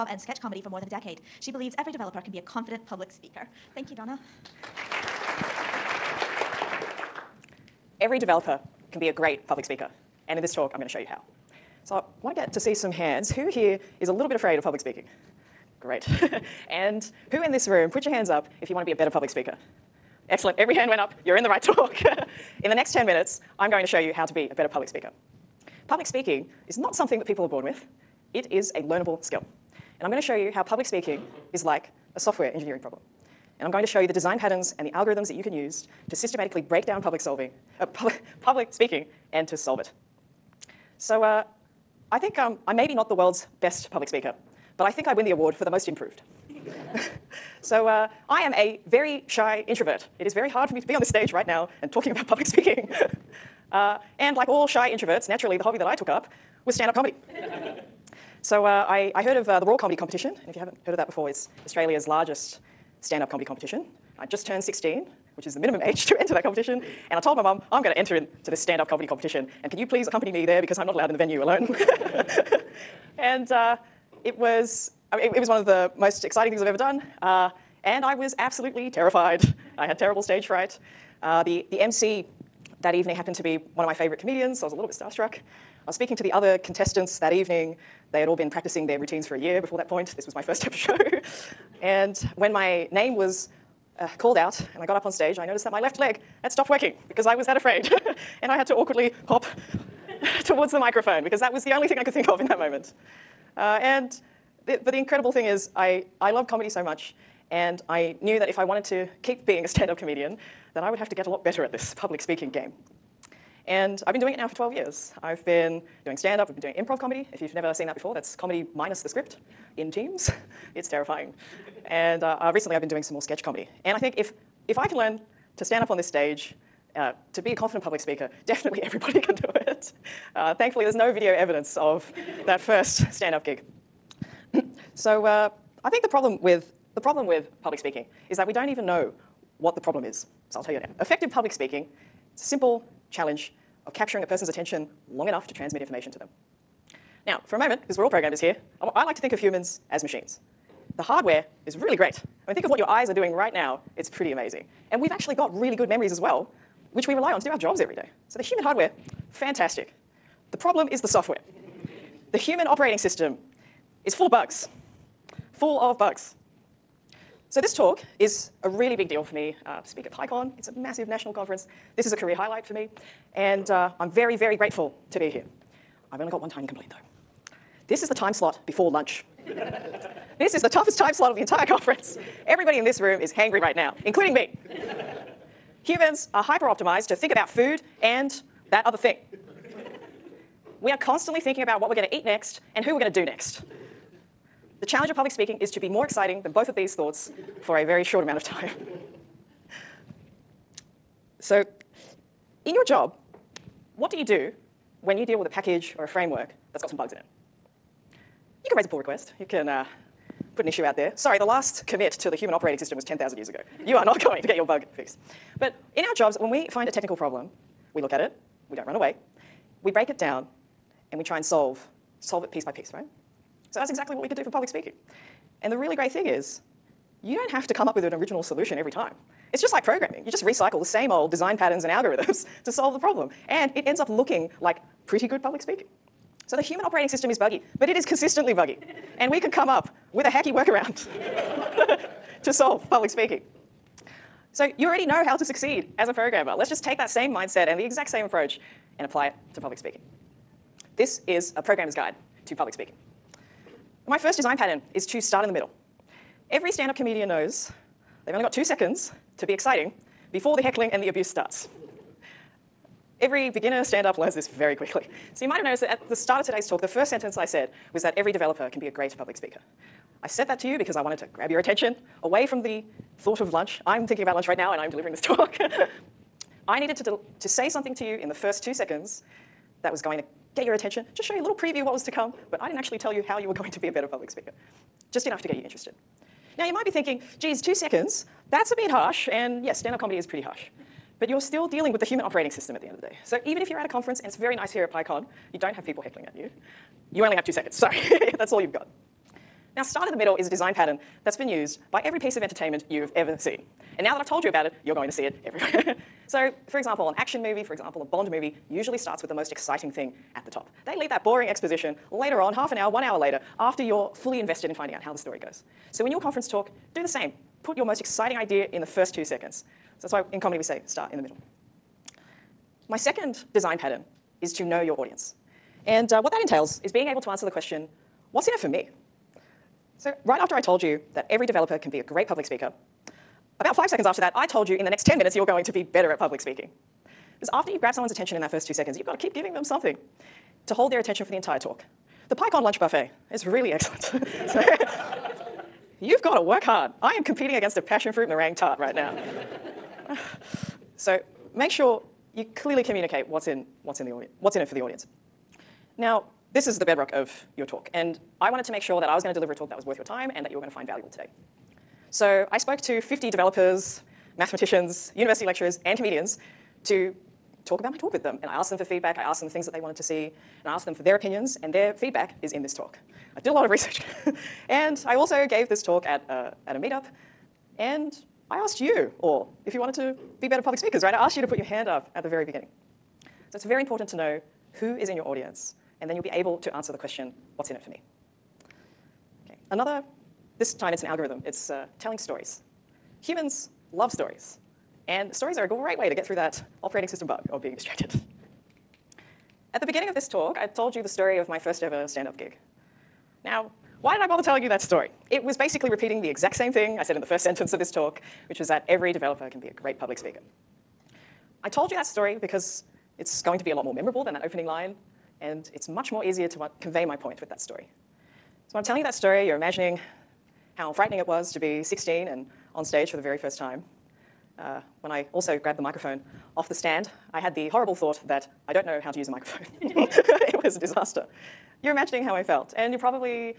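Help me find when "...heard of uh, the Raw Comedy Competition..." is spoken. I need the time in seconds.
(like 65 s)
59 s.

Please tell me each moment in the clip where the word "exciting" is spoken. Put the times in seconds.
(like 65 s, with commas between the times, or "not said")
76 s, 196 s, 259 s, 309 s, 317 s.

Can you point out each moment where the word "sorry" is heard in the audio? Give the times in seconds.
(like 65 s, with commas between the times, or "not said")
211 s, 297 s.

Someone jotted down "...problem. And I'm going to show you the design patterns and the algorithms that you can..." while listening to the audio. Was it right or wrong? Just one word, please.
right.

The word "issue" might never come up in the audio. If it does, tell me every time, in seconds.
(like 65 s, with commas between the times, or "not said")
210 s.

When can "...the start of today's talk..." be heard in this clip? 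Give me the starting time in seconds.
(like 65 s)
266 s.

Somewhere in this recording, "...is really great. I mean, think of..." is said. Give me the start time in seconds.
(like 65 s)
151 s.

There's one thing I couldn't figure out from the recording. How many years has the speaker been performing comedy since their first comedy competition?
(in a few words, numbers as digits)
12 years.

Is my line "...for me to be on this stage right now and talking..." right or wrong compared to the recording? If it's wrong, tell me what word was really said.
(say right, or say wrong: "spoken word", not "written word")
right.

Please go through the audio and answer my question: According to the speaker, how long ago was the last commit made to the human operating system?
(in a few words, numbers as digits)
10,000 years ago.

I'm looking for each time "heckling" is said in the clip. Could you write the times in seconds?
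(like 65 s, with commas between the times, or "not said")
260 s, 296 s.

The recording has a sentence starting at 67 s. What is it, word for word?
And I told my mum, I'm going to enter into this stand up comedy competition.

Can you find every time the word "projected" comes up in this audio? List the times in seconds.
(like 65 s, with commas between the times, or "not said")
not said.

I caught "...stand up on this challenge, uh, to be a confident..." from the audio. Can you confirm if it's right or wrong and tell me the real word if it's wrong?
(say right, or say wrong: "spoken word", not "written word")
wrong: "stage", not "challenge".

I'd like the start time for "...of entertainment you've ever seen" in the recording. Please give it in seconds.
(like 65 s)
302 s.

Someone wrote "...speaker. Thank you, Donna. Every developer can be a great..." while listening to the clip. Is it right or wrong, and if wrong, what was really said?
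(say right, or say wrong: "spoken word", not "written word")
right.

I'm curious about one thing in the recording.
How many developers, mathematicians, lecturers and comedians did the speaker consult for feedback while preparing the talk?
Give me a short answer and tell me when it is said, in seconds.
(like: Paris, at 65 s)
50, at 363 s.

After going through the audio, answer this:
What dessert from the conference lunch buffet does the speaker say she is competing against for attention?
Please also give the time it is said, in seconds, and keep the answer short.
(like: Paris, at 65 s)
Passion fruit meringue tart, at 347 s.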